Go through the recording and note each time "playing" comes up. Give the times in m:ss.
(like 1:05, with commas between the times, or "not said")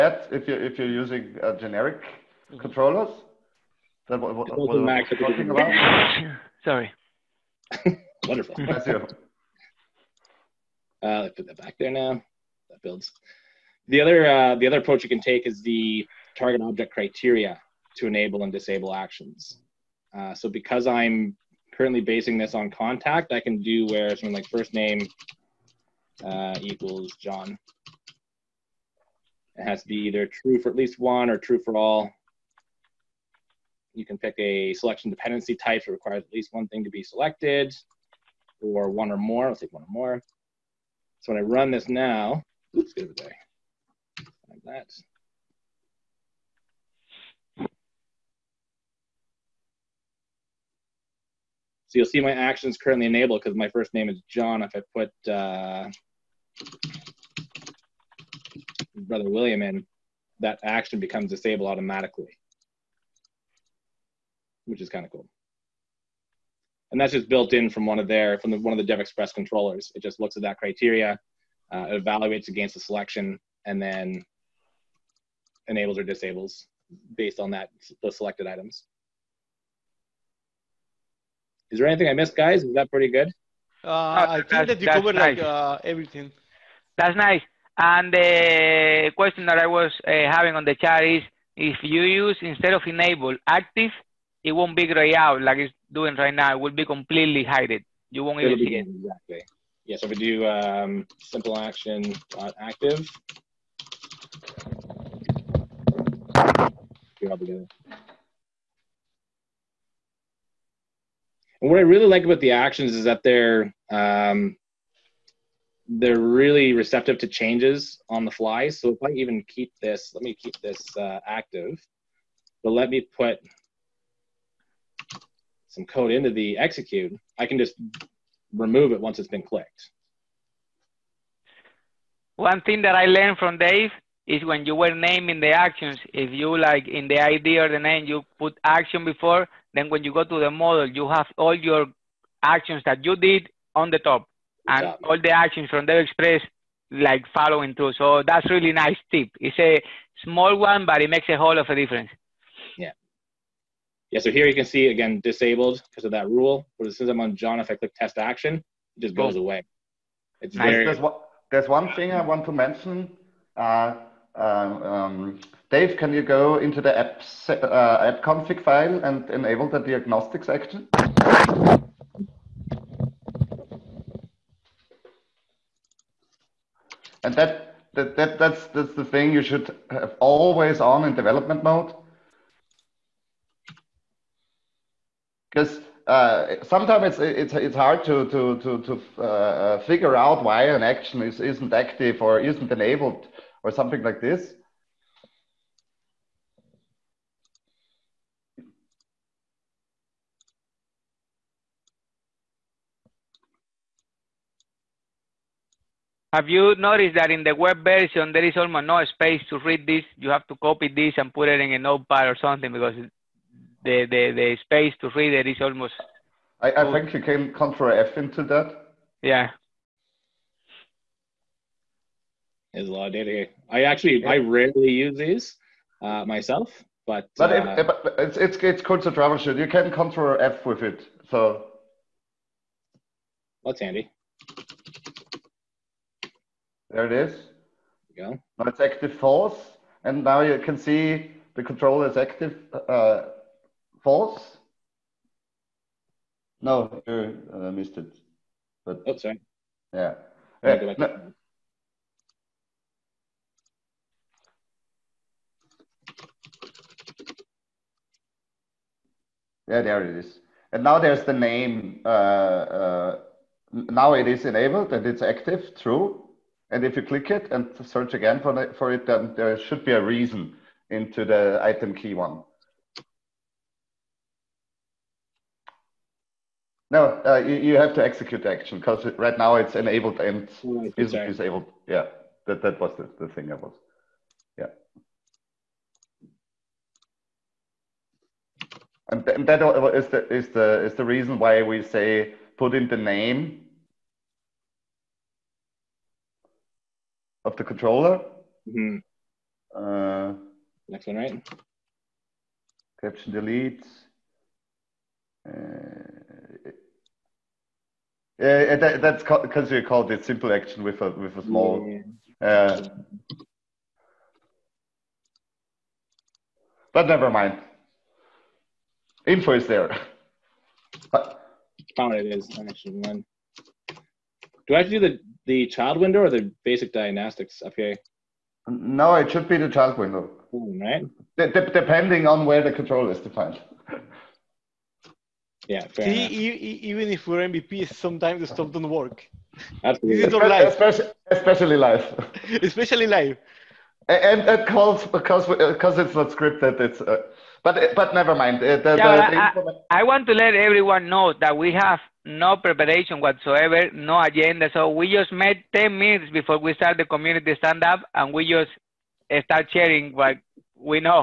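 not said.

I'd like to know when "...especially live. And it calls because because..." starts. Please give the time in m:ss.
5:42.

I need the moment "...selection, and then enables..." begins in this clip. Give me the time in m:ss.
1:12.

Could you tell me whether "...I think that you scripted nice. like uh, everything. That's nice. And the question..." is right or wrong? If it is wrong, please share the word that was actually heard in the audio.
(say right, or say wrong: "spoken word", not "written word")
wrong: "covered", not "scripted".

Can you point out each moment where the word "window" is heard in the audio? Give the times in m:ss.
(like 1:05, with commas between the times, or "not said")
5:25, 5:29.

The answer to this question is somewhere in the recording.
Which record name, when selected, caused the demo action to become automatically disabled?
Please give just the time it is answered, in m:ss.
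0:58.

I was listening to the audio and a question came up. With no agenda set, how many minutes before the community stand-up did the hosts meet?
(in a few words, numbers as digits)
10.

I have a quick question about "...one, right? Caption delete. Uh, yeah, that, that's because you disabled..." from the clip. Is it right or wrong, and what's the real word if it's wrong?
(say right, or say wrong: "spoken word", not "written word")
wrong: "called", not "disabled".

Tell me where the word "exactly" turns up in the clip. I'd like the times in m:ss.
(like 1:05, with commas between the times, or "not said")
1:38, 2:24.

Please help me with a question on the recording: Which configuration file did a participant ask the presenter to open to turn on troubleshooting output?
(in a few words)
app config.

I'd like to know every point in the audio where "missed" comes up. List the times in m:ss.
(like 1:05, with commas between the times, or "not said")
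1:22, 4:07.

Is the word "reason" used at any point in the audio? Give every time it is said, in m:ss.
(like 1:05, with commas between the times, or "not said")
4:30, 4:51.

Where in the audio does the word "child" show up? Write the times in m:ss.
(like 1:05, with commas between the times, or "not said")
5:25, 5:29.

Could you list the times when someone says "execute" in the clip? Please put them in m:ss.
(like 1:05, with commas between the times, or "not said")
2:06, 4:38.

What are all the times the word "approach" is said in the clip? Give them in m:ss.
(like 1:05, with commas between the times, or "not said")
0:14.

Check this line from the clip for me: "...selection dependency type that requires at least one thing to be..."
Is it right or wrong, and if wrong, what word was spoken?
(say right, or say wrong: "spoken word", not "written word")
right.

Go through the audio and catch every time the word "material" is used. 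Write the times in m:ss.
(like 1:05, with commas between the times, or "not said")
not said.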